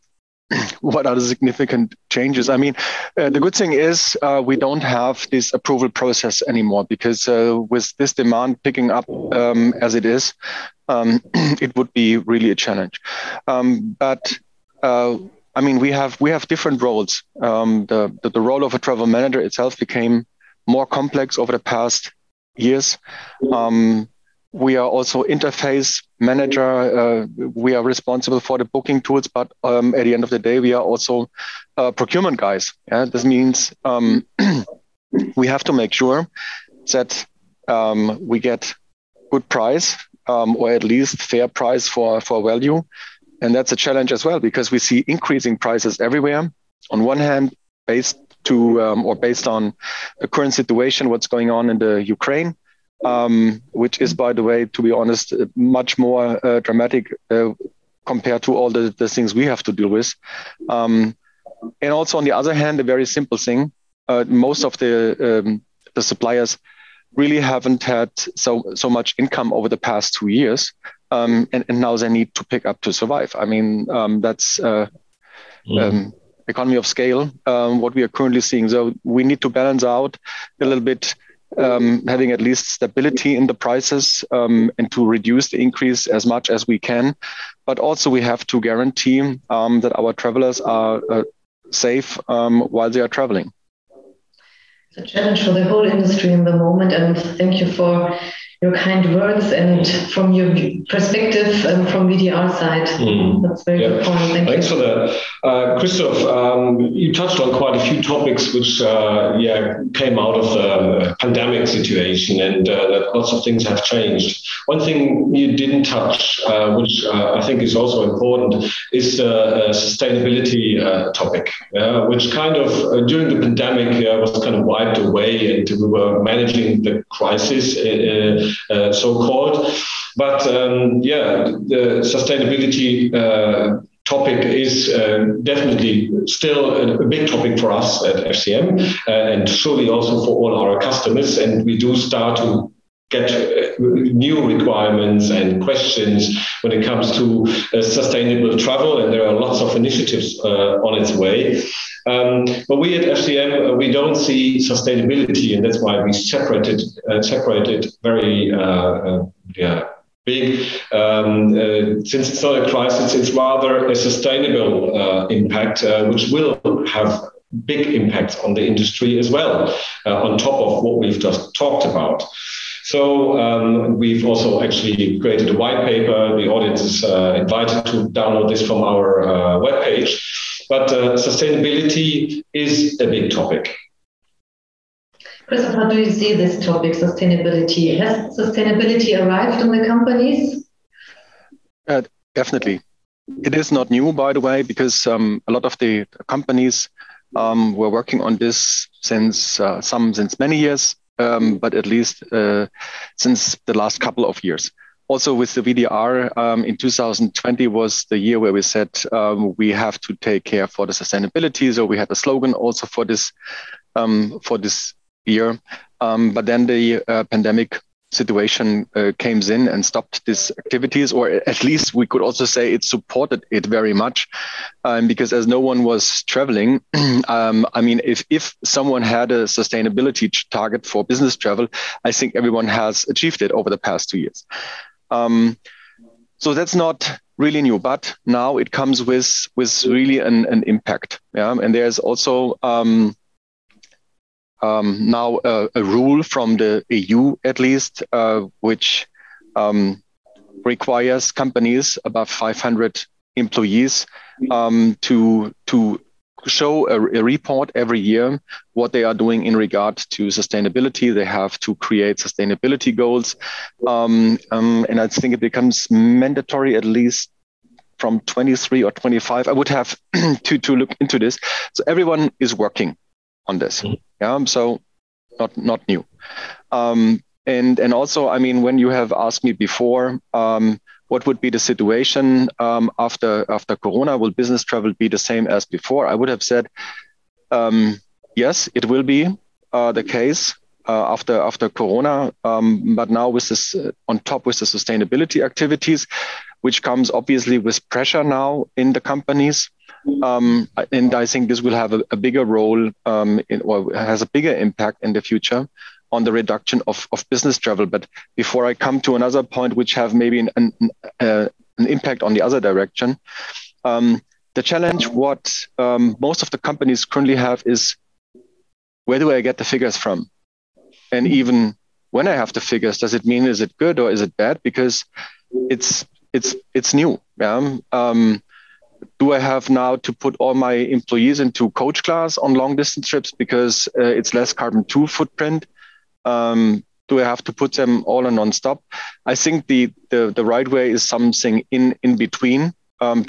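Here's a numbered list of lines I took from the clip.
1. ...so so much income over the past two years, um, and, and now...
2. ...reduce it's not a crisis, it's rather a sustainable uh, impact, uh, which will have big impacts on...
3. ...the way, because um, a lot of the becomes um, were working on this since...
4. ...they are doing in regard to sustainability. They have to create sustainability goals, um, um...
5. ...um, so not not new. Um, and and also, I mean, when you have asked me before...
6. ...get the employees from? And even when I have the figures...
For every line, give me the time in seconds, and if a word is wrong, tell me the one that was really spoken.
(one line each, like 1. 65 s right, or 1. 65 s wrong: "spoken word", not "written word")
1. 68 s right
2. 162 s wrong: "since", not "reduce"
3. 194 s wrong: "companies", not "becomes"
4. 258 s right
5. 274 s right
6. 319 s wrong: "figures", not "employees".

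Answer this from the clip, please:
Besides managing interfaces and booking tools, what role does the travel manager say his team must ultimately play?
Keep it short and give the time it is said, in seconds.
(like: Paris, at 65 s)
procurement guys, at 31 s.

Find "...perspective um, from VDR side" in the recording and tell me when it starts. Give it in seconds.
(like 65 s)
100 s.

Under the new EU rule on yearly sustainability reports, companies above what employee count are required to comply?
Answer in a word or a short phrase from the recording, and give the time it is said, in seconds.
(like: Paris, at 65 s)
500, at 252 s.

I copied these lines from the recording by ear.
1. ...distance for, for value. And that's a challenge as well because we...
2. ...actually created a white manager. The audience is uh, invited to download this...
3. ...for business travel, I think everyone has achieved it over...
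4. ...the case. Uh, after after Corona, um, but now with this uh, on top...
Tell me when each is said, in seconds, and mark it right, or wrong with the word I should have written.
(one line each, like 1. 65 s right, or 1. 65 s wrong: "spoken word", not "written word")
1. 41 s wrong: "price", not "distance"
2. 174 s wrong: "paper", not "manager"
3. 230 s right
4. 289 s right.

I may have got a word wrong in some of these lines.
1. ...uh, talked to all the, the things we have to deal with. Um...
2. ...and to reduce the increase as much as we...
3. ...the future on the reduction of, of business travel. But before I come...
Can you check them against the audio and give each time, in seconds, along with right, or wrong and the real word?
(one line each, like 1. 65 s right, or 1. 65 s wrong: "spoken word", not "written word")
1. 57 s wrong: "compared", not "talked"
2. 84 s right
3. 305 s right.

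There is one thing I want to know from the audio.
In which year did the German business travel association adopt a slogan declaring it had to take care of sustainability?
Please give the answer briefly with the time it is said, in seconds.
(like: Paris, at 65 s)
2020, at 206 s.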